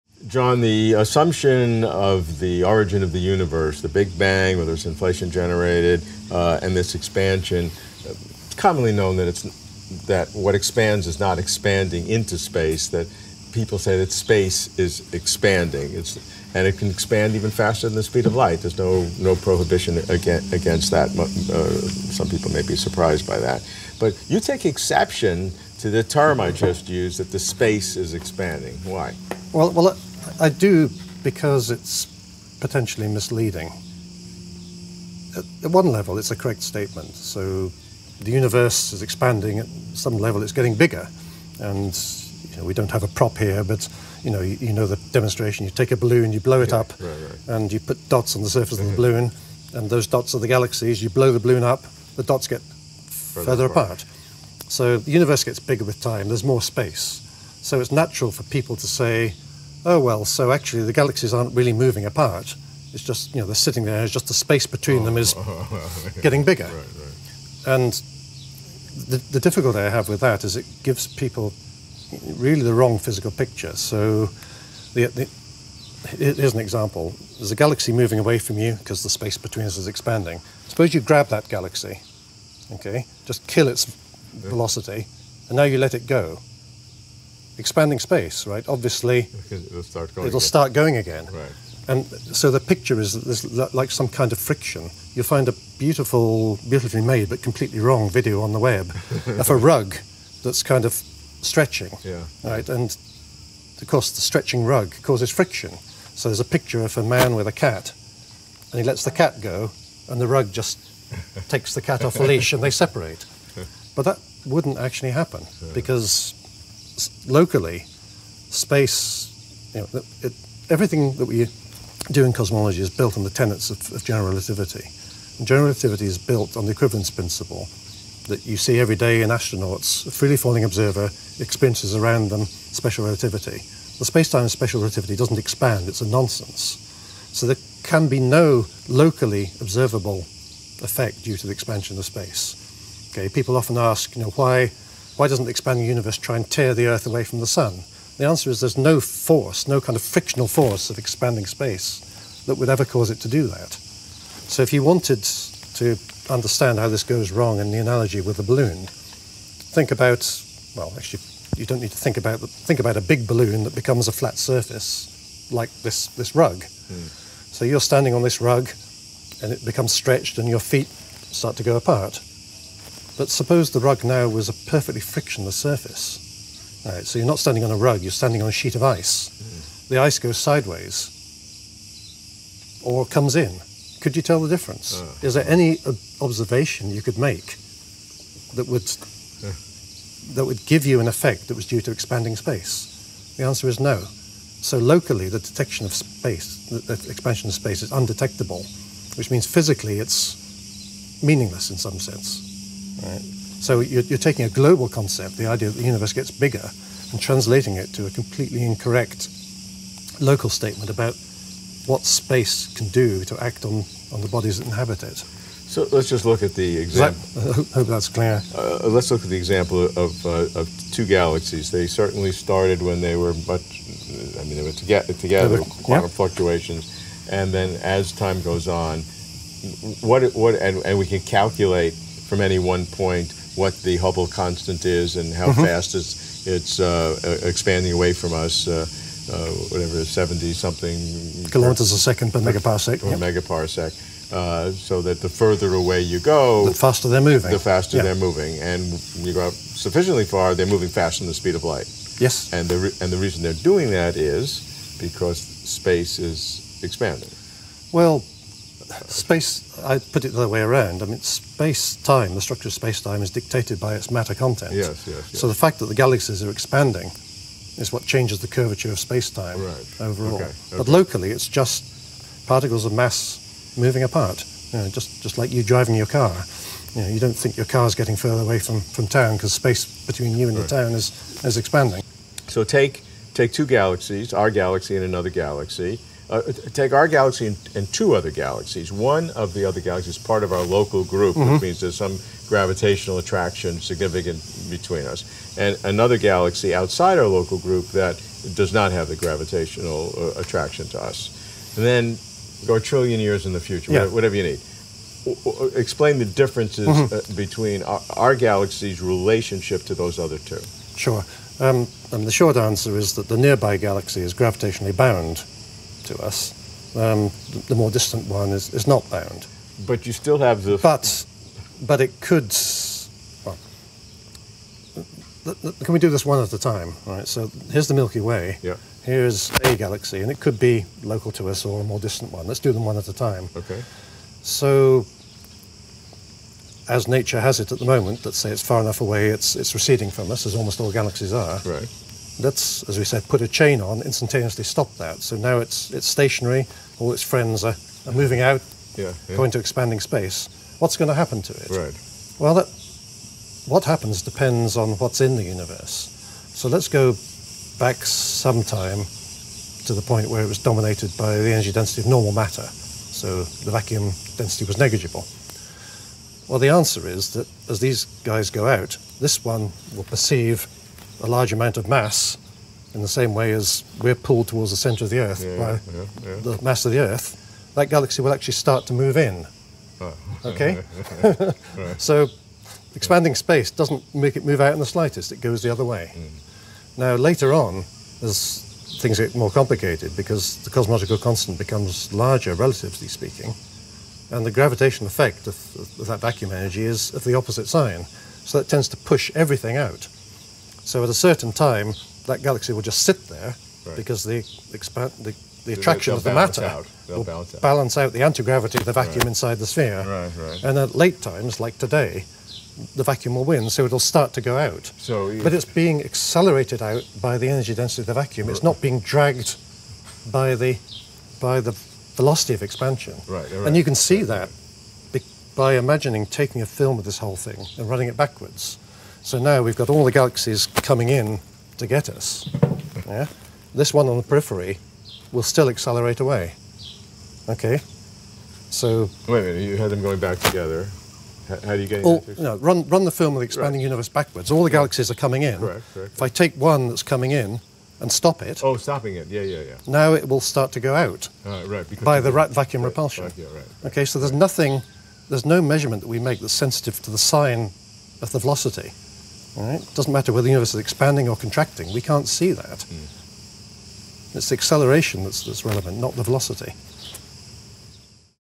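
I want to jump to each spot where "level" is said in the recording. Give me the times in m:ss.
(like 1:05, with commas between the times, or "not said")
0:35, 0:40.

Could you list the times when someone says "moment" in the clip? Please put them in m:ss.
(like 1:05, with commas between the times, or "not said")
5:37.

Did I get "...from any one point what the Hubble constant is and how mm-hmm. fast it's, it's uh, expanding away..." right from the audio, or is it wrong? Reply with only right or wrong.
right.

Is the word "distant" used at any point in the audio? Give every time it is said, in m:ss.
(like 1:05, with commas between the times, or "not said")
5:17, 5:31.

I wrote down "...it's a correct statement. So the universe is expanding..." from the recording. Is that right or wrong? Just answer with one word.
right.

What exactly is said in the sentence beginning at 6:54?
So, But it's being accelerated out by the energy density of the vacuum.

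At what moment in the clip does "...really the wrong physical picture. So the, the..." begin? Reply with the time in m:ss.
1:12.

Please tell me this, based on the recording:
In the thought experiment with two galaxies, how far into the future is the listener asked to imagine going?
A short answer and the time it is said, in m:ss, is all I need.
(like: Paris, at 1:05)
A trillion years, at 5:02.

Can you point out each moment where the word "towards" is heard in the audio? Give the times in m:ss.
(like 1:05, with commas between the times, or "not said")
6:14.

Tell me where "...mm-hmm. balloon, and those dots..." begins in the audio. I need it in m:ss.
0:48.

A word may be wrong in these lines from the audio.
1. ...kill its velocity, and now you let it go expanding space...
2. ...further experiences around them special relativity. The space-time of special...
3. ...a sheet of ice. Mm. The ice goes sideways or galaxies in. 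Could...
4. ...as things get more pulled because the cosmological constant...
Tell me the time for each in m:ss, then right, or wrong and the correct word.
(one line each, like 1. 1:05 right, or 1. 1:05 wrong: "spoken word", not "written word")
1. 1:23 right
2. 2:10 wrong: "observer", not "further"
3. 2:58 wrong: "comes", not "galaxies"
4. 6:28 wrong: "complicated", not "pulled".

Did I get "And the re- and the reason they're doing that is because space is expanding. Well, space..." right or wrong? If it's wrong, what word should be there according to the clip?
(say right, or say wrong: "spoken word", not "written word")
right.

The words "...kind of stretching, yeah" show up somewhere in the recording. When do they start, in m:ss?
1:40.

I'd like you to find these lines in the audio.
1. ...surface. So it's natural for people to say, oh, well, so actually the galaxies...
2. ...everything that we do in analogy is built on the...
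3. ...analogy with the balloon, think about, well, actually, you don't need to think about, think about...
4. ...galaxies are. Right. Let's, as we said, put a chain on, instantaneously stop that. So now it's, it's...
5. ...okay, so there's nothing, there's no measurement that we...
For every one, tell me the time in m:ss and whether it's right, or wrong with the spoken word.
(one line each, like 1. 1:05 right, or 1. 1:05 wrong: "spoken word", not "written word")
1. 0:56 wrong: "space", not "surface"
2. 2:00 wrong: "cosmology", not "analogy"
3. 2:37 right
4. 5:40 right
5. 7:33 right.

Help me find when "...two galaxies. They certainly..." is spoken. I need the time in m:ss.
3:40.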